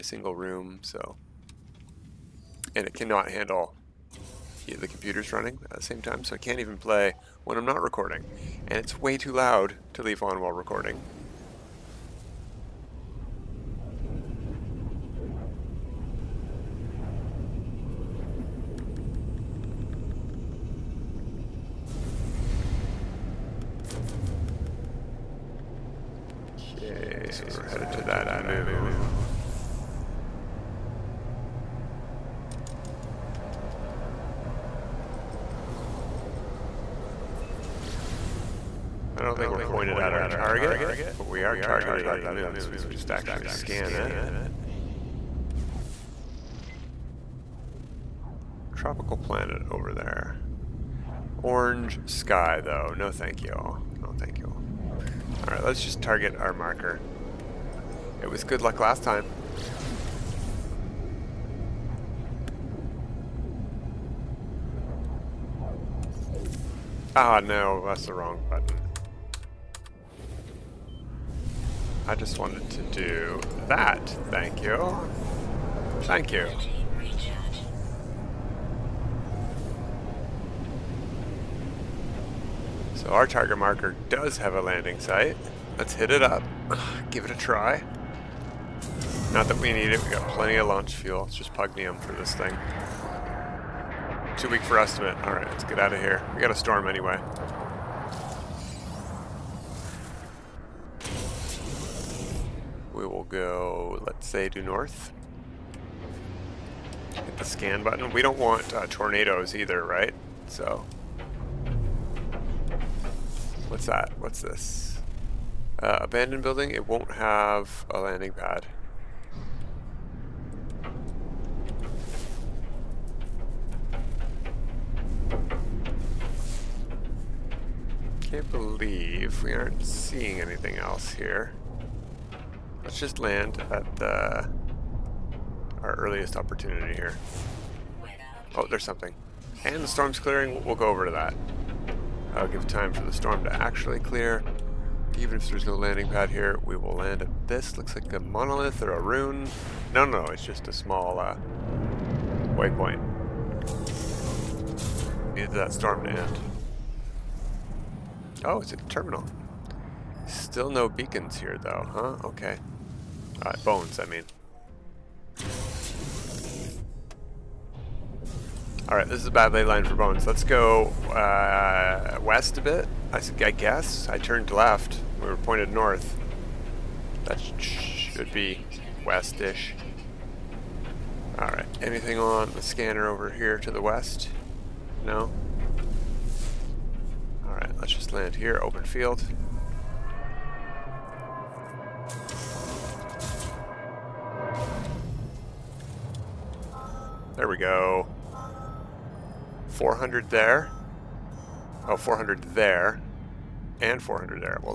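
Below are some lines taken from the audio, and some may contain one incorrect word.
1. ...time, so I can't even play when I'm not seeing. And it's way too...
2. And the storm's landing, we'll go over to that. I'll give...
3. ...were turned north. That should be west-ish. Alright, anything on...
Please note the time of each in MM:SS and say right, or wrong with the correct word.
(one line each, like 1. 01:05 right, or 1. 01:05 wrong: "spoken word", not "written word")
1. 00:06 wrong: "recording", not "seeing"
2. 02:19 wrong: "clearing", not "landing"
3. 02:55 wrong: "pointed", not "turned".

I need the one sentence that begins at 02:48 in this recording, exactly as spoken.
Alright, this is a bad ley line for bones.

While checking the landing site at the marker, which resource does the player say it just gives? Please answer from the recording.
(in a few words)
Pugneum.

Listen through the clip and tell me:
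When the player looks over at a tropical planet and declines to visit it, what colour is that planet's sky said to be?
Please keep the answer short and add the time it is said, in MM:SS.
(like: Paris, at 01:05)
Orange, at 00:51.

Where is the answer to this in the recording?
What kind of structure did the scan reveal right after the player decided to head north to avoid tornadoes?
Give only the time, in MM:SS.
01:55.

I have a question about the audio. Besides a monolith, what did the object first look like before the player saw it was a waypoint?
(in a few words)
A rune.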